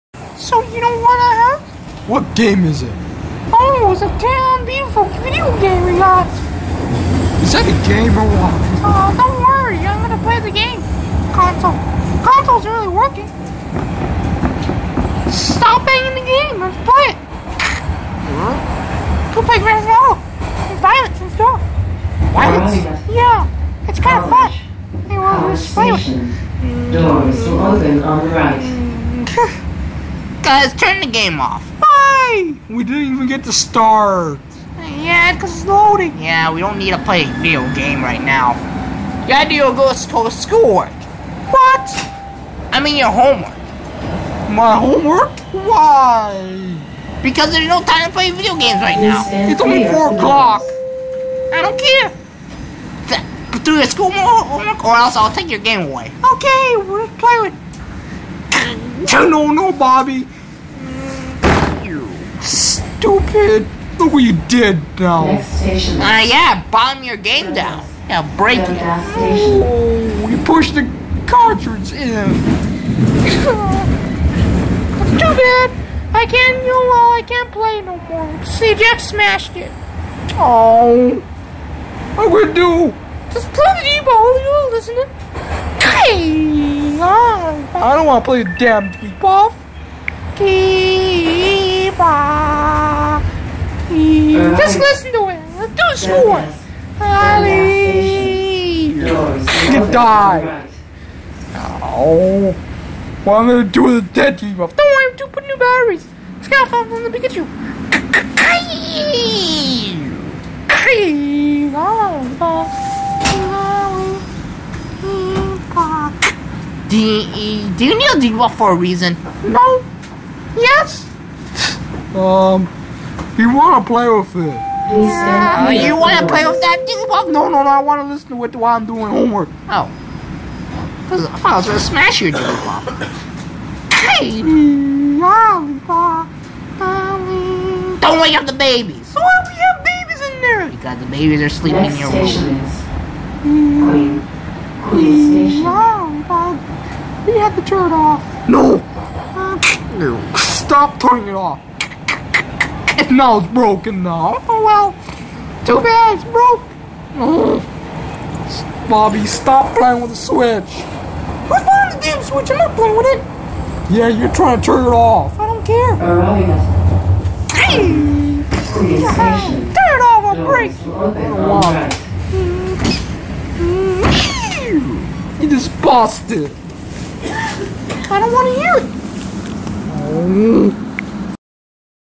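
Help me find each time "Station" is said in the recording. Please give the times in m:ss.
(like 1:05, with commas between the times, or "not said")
2:25.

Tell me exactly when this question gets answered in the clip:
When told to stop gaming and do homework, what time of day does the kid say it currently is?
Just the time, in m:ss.
0:49.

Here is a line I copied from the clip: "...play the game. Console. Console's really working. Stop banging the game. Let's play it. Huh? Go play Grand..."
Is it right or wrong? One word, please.
right.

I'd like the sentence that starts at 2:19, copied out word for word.
Why do we have babies in there?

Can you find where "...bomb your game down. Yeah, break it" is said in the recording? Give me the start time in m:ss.
1:06.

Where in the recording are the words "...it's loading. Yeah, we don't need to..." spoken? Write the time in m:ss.
0:35.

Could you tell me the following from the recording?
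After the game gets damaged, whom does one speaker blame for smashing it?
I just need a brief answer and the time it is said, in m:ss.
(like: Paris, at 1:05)
CJF, at 1:18.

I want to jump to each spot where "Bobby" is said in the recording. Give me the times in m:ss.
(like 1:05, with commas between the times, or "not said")
0:59, 2:38.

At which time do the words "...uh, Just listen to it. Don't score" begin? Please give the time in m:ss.
1:34.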